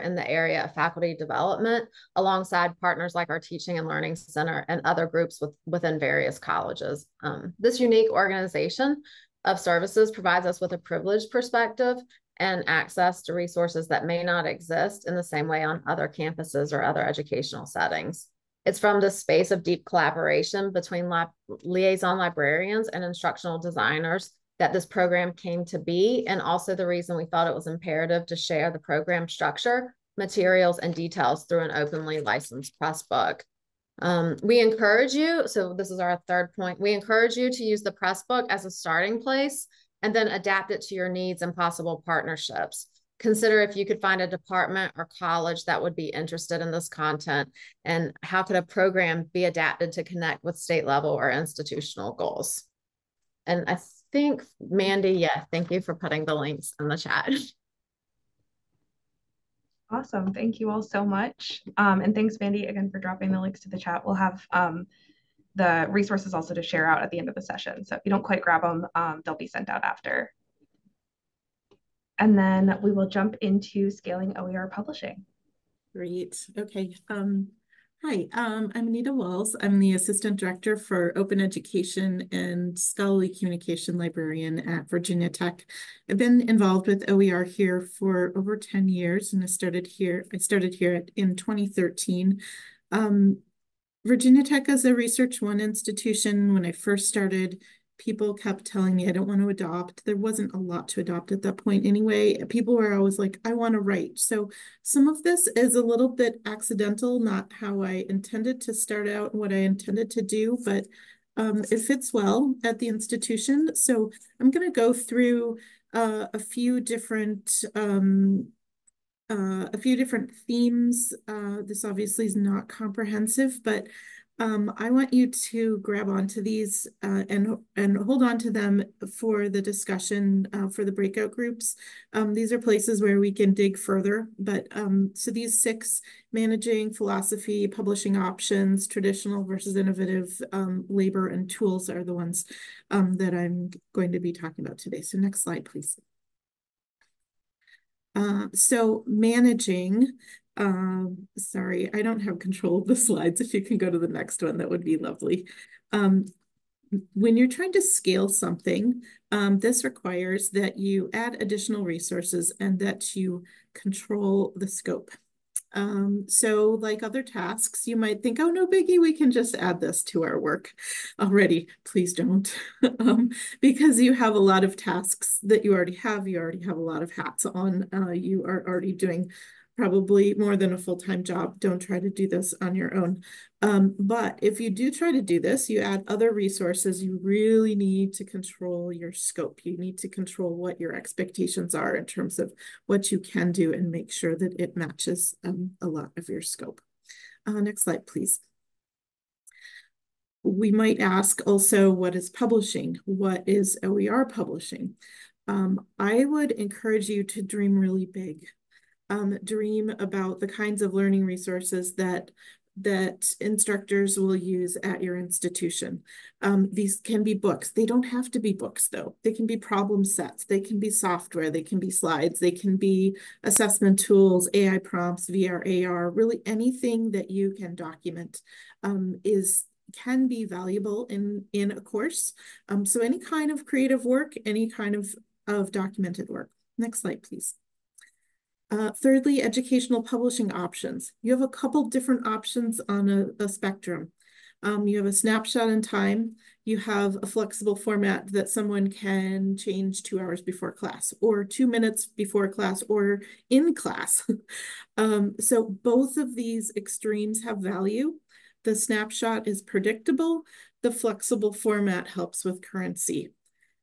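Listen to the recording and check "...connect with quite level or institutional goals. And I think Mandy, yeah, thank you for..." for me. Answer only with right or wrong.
wrong.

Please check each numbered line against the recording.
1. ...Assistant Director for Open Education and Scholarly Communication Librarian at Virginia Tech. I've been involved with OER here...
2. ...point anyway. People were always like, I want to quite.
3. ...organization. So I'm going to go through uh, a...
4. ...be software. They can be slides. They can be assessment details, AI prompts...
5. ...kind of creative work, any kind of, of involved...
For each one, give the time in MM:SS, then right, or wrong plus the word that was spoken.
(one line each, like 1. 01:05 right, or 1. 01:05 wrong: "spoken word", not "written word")
1. 01:19 right
2. 01:41 wrong: "write", not "quite"
3. 01:52 wrong: "institution", not "organization"
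4. 03:40 wrong: "tools", not "details"
5. 03:53 wrong: "documented", not "involved".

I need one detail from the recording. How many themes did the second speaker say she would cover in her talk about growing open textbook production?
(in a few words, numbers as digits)
6.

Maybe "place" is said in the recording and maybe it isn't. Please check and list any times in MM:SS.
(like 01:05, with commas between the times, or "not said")
00:39, 02:12.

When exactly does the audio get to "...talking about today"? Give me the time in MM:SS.
02:24.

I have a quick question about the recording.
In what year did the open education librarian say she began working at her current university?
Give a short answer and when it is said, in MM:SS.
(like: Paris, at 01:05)
2013, at 01:31.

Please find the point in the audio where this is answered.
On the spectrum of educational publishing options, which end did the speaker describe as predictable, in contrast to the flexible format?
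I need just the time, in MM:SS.
04:05.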